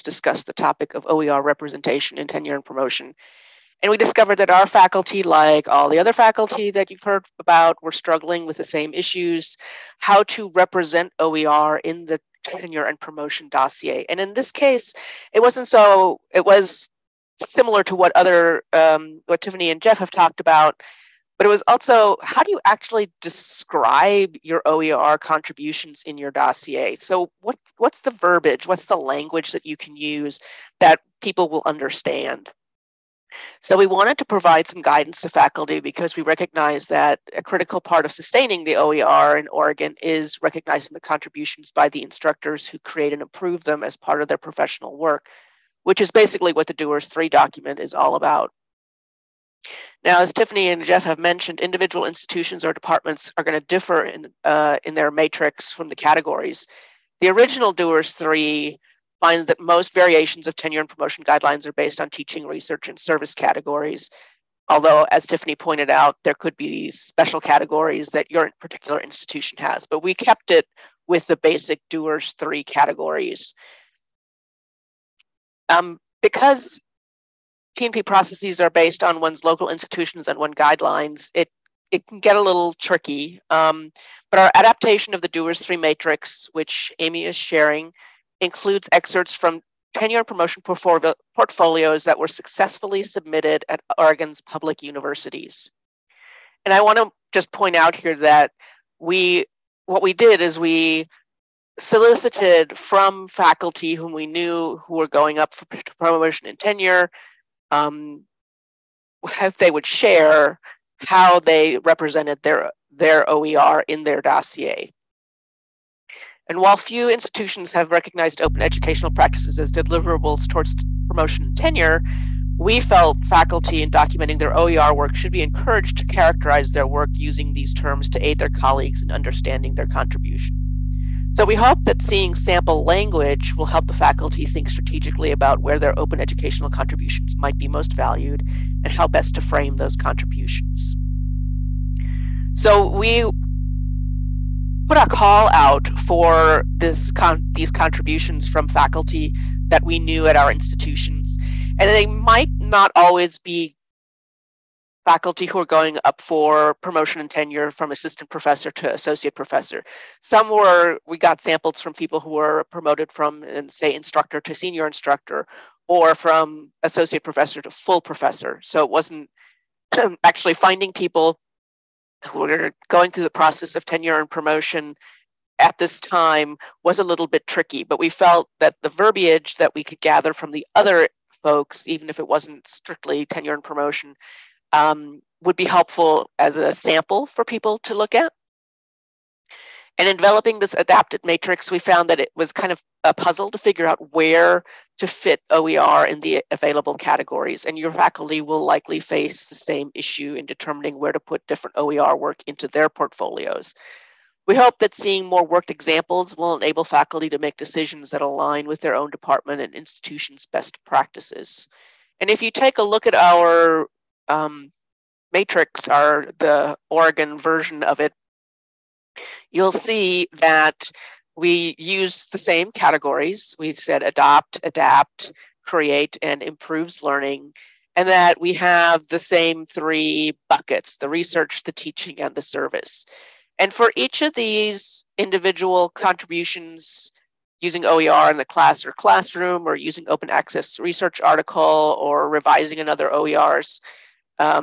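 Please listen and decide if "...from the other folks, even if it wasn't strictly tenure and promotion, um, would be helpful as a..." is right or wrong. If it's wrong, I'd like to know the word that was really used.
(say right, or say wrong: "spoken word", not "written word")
right.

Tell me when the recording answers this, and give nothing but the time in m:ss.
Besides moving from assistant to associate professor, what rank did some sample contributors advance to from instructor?
2:44.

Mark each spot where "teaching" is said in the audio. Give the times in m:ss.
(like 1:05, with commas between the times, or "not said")
1:02, 3:51.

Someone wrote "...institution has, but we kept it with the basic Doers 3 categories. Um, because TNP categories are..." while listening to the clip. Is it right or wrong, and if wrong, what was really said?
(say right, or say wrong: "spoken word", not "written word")
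wrong: "processes", not "categories".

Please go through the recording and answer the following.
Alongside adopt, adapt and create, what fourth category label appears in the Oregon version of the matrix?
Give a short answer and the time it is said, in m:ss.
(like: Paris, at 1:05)
Improves learning, at 3:46.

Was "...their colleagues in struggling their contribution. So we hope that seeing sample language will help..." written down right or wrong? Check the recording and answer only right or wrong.
wrong.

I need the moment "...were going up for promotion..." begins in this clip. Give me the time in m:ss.
1:44.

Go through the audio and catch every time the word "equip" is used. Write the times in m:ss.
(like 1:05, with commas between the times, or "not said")
not said.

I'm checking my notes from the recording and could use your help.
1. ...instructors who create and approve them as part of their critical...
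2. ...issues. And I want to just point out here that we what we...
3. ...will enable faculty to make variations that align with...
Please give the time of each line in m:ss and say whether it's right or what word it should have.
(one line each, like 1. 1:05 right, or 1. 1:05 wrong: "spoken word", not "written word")
1. 0:42 wrong: "professional", not "critical"
2. 1:34 wrong: "universities", not "issues"
3. 3:26 wrong: "decisions", not "variations".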